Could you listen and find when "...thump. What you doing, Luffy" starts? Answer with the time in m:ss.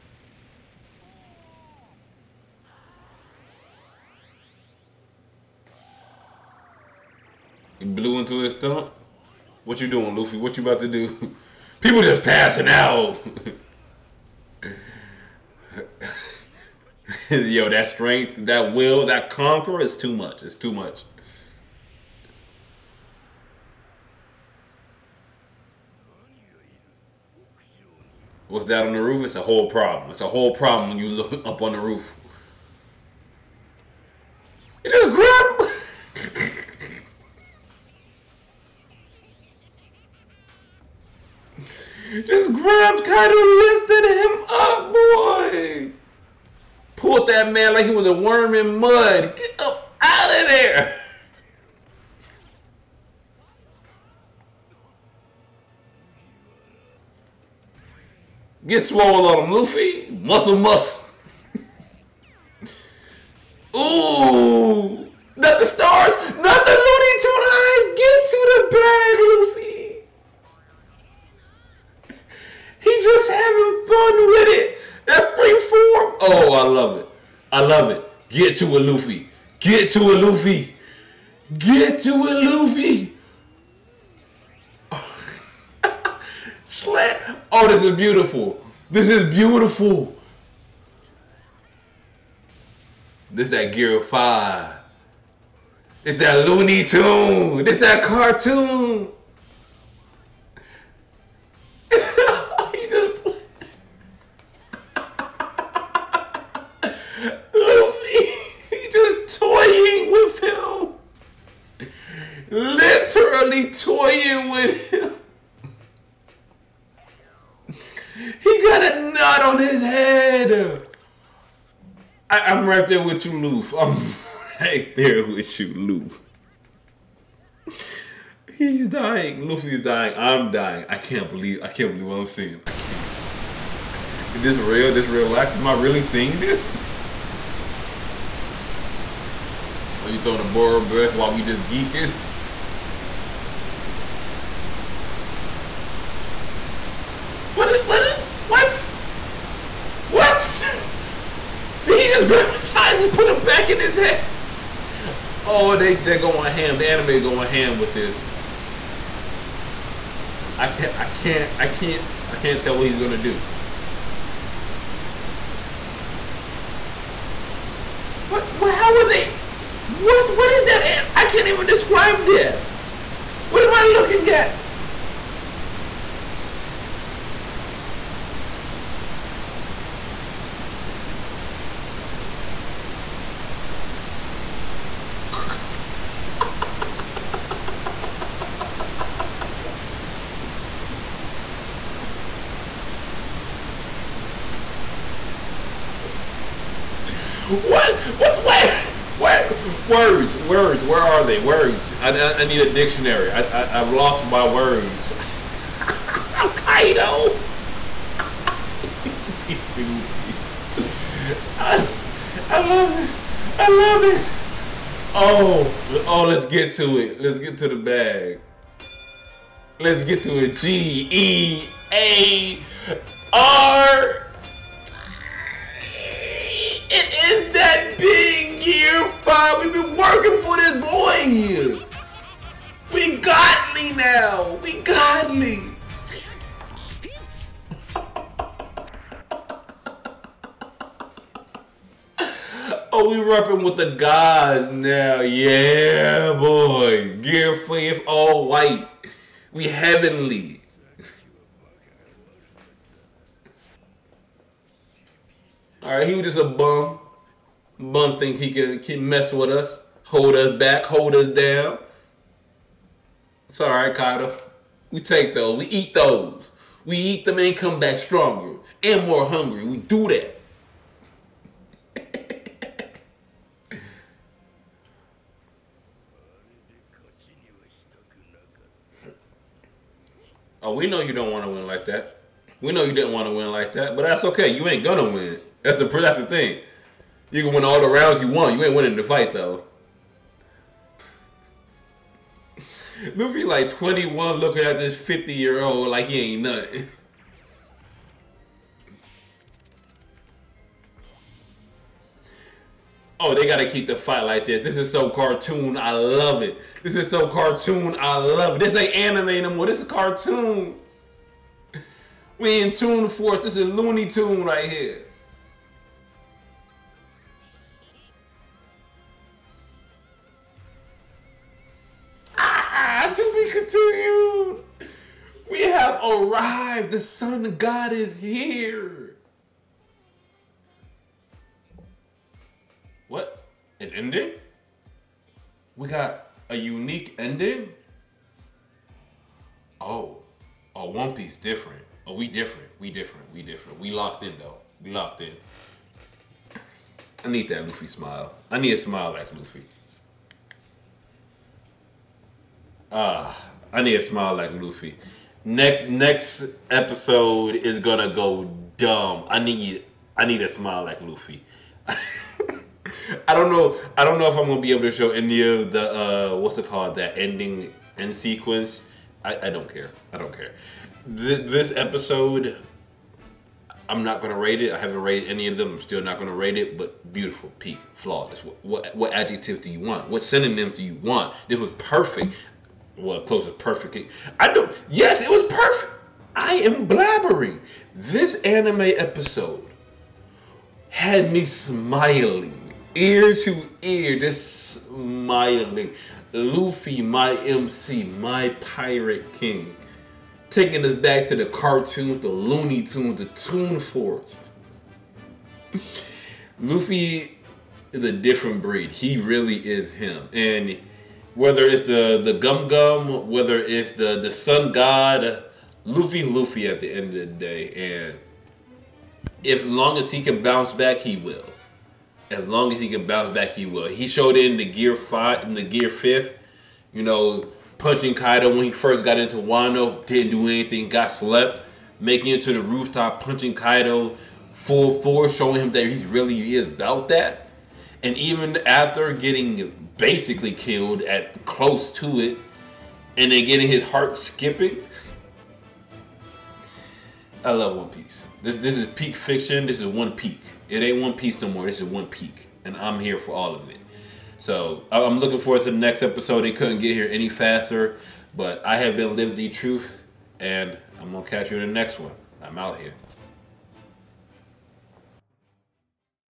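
0:08.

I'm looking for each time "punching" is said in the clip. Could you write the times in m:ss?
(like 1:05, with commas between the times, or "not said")
7:07, 7:13.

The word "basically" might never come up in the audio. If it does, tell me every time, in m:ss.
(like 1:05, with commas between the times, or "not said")
7:19.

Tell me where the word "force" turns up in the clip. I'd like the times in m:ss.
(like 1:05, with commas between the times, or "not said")
5:13, 7:15.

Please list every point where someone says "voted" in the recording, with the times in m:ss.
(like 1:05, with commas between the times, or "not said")
not said.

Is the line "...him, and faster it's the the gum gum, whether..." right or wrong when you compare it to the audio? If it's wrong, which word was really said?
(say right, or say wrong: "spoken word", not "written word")
wrong: "whether", not "faster".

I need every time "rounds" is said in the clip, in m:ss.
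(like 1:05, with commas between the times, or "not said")
4:47.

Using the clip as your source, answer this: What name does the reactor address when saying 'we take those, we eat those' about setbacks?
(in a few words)
Kyle.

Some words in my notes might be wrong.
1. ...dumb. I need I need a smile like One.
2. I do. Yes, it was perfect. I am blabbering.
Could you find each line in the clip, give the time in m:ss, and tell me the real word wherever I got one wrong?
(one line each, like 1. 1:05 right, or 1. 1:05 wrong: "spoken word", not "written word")
1. 5:58 wrong: "Luffy", not "One"
2. 6:24 right.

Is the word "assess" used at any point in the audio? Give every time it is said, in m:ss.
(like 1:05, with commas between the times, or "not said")
not said.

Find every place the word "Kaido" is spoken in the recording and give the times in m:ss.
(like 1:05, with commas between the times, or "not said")
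7:08, 7:13.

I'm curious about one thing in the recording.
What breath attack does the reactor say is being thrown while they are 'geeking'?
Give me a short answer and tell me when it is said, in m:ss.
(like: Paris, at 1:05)
Boro Breath, at 2:20.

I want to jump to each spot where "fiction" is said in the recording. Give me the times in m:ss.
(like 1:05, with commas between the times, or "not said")
7:29.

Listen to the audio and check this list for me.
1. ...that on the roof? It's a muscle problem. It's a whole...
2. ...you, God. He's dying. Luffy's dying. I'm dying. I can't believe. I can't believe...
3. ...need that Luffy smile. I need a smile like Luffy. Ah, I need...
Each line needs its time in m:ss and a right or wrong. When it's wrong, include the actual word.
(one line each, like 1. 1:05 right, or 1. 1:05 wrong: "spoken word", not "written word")
1. 0:28 wrong: "whole", not "muscle"
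2. 2:05 wrong: "Loof", not "God"
3. 5:47 right.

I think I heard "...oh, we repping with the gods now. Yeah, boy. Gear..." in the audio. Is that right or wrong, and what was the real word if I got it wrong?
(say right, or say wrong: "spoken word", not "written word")
right.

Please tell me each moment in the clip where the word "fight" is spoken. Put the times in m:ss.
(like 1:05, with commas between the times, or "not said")
4:49, 5:03.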